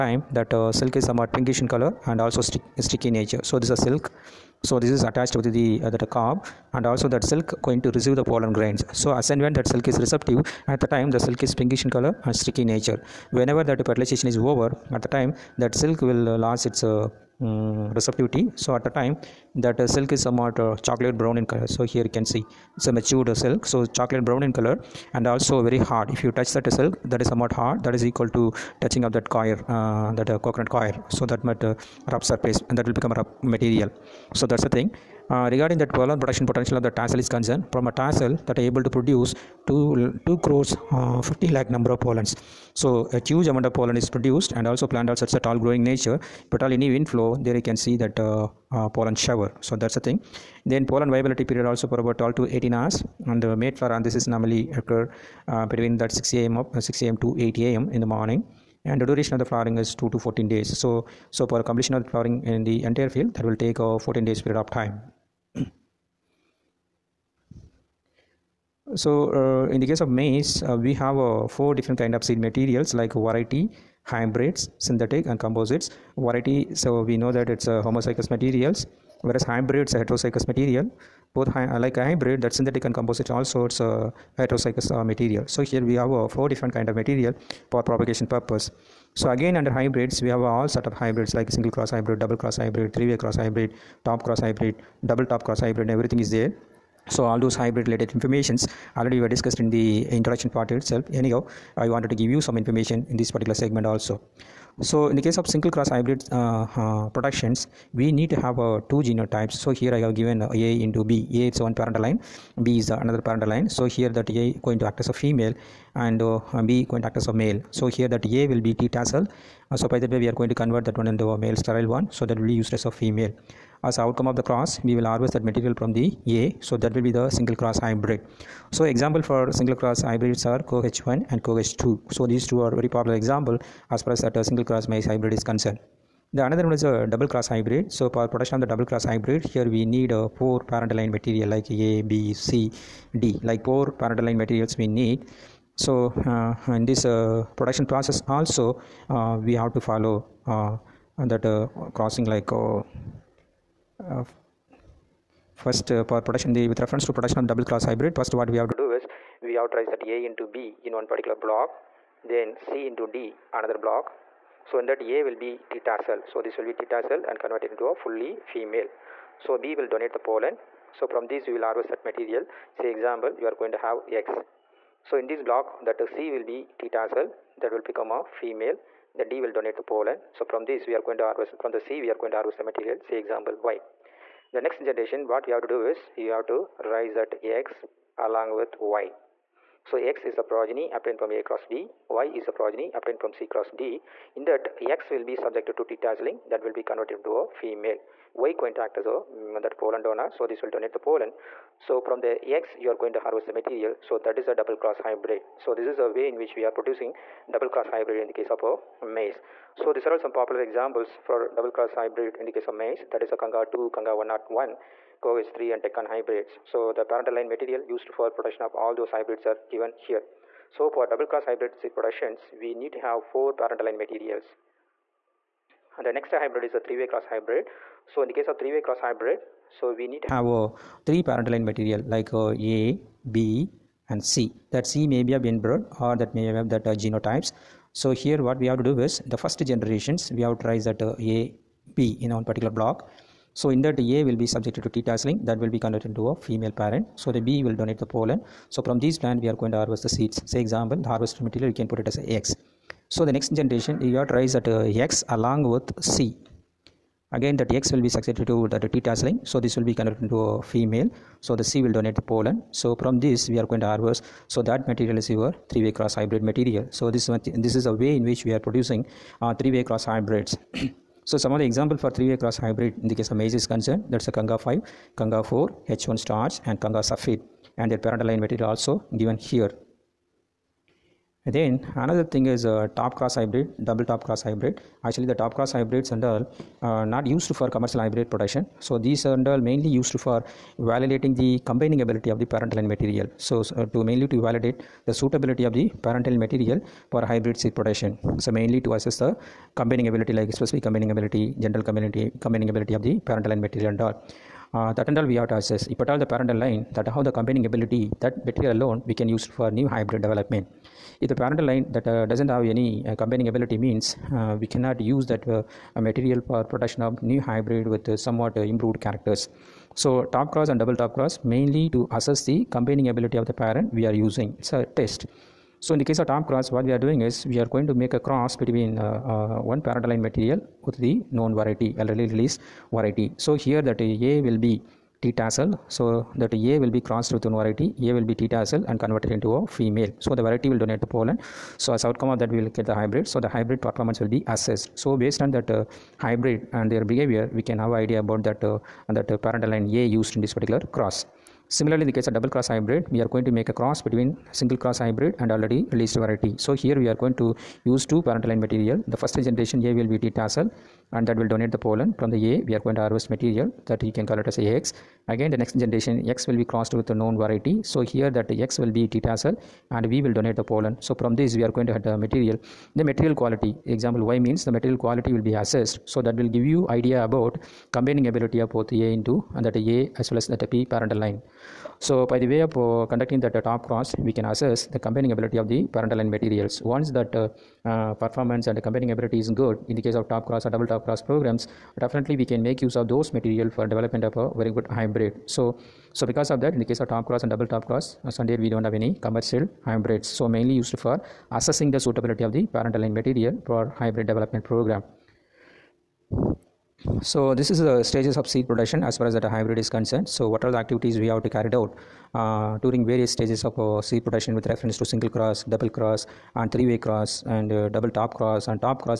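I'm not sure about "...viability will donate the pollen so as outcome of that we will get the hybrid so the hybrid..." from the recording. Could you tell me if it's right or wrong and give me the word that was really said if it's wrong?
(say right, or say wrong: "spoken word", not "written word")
wrong: "variety", not "viability".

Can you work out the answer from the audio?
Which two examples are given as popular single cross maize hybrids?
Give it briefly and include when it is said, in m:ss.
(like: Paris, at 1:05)
CoH1 and CoH2, at 2:10.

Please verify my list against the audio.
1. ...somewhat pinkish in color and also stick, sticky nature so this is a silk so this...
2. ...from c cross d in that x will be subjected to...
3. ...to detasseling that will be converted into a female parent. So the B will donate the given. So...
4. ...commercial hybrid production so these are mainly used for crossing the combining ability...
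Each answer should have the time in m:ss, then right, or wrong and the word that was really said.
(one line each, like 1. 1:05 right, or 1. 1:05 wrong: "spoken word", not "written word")
1. 0:01 right
2. 3:13 right
3. 4:04 wrong: "pollen", not "given"
4. 4:47 wrong: "validating", not "crossing".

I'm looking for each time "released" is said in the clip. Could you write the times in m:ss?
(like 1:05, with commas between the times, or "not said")
5:32, 5:55.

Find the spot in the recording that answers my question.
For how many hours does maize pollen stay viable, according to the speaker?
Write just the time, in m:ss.
0:52.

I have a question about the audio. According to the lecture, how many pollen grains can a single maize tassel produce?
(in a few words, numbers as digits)
2 crore 50 lakh.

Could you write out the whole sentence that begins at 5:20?
So top cross and double top cross mainly to assess the combining ability of the parent we are using.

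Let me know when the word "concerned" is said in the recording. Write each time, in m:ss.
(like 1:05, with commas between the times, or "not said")
0:37, 2:15, 4:33, 6:49.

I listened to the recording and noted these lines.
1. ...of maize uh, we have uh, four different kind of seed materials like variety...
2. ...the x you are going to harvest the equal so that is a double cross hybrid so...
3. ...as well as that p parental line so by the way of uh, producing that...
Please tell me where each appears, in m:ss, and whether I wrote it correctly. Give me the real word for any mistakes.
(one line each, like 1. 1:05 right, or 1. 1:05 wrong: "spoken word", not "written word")
1. 1:09 right
2. 3:22 wrong: "material", not "equal"
3. 6:20 wrong: "conducting", not "producing".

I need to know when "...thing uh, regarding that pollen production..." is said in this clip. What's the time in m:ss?
0:34.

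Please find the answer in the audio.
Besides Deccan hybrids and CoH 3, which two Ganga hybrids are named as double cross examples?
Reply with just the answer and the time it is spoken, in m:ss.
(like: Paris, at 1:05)
Ganga 2 and Ganga 101, at 3:33.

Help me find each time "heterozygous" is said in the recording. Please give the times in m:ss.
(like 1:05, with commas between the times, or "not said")
1:19, 1:24.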